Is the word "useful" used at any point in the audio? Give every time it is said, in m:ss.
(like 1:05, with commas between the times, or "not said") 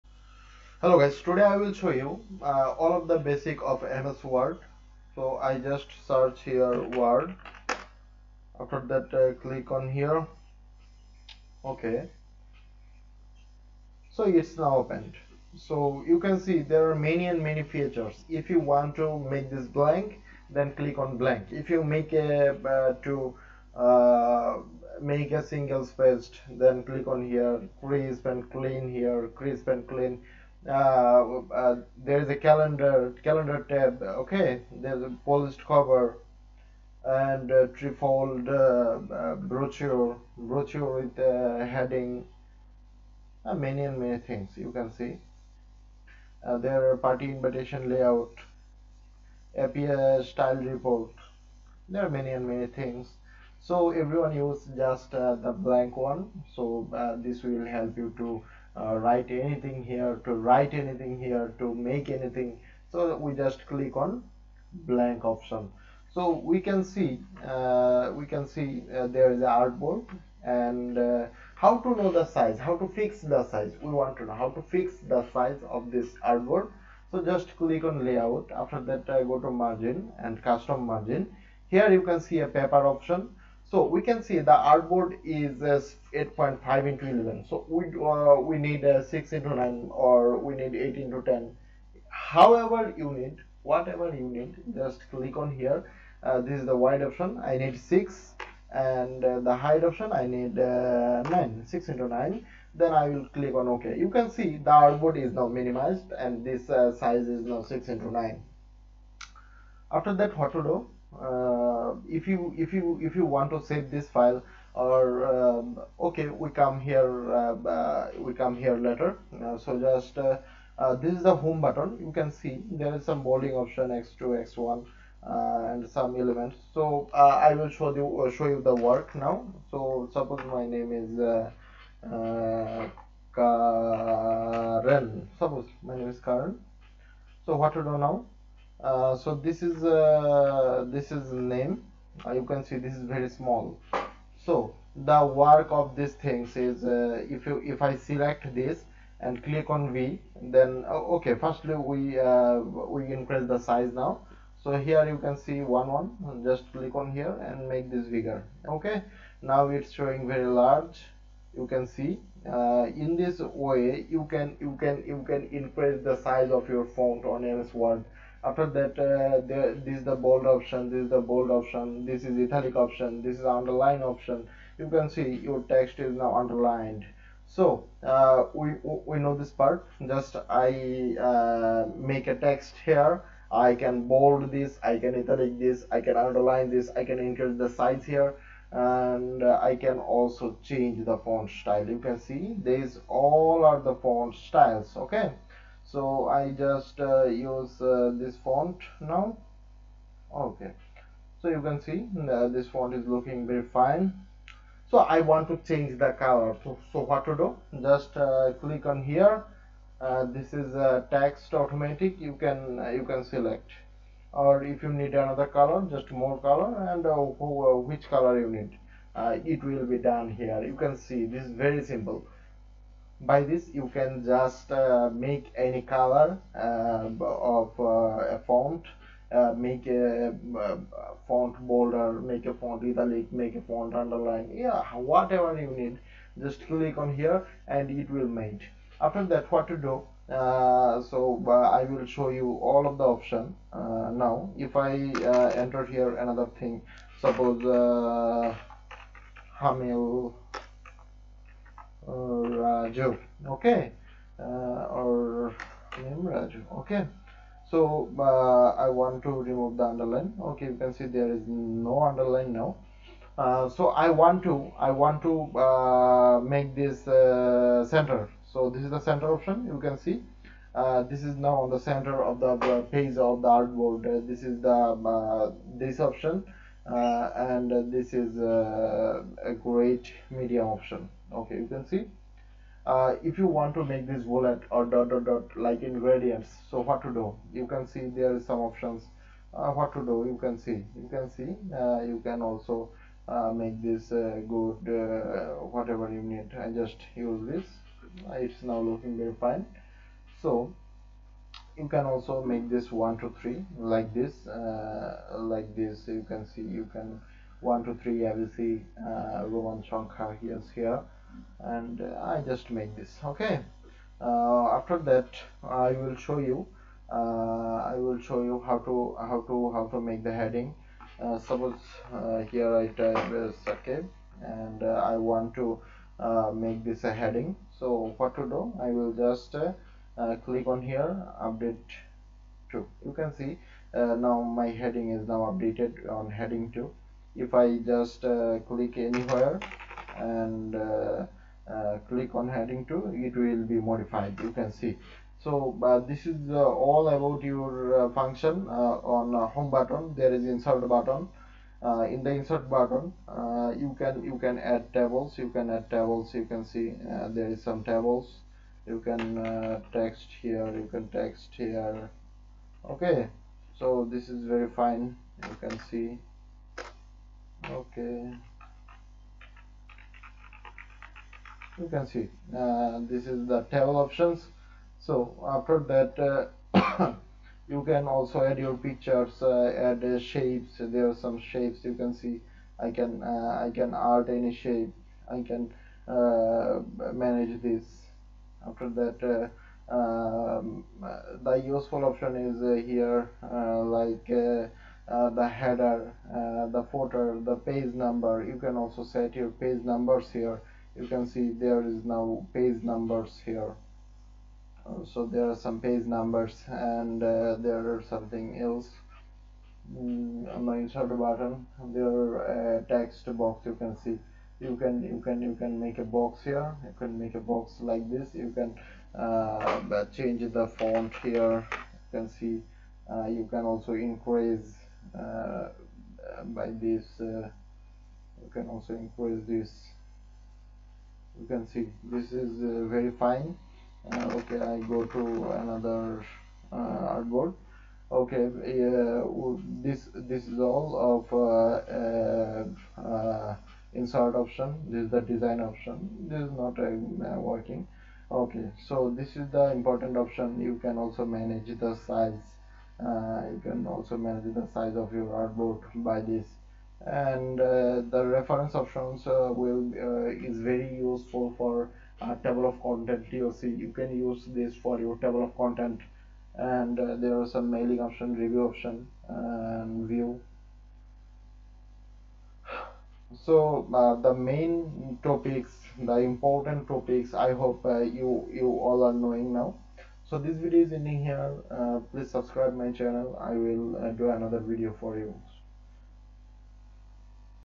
6:31, 7:40.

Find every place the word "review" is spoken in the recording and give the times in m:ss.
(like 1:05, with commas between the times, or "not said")
7:48.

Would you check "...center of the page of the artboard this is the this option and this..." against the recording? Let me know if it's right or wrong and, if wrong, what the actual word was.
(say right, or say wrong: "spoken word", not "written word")
right.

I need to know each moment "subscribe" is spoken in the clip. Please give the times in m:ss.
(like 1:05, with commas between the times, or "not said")
8:02.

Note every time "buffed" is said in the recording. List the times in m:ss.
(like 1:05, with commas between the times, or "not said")
not said.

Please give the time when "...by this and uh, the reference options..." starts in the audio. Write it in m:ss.
7:36.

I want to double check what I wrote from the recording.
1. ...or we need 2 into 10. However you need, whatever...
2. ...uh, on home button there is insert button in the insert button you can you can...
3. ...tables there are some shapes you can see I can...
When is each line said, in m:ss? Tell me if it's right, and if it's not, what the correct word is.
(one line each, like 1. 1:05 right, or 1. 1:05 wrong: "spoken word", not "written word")
1. 1:29 wrong: "8", not "2"
2. 5:48 right
3. 6:20 wrong: "shapes", not "tables".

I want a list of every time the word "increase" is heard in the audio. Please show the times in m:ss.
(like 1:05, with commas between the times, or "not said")
2:33, 2:45, 3:07, 7:03, 7:08.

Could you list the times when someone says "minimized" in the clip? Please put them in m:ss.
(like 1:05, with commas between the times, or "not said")
1:45.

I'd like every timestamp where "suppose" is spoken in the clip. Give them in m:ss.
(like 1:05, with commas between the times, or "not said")
2:10, 2:15, 4:07, 5:21.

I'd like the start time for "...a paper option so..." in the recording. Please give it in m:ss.
1:22.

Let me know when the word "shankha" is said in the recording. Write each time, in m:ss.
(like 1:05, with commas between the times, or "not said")
5:09.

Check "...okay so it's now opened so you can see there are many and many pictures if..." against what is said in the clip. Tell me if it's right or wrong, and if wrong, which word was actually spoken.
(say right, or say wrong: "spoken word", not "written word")
wrong: "features", not "pictures".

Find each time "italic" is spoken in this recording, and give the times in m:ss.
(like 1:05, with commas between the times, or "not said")
2:52, 3:05, 3:52.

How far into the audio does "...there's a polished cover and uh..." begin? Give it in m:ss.
0:34.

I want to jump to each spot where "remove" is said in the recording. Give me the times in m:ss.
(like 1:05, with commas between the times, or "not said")
4:19.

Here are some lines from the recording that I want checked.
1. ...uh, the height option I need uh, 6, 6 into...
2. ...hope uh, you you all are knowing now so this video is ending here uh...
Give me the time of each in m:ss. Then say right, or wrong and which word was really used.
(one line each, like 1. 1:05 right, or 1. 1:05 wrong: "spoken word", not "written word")
1. 1:39 wrong: "9", not "6"
2. 7:57 right.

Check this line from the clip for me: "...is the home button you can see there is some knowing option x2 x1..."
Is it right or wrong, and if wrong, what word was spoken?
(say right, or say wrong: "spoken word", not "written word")
wrong: "bolding", not "knowing".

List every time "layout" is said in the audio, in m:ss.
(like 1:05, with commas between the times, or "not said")
0:47, 1:18.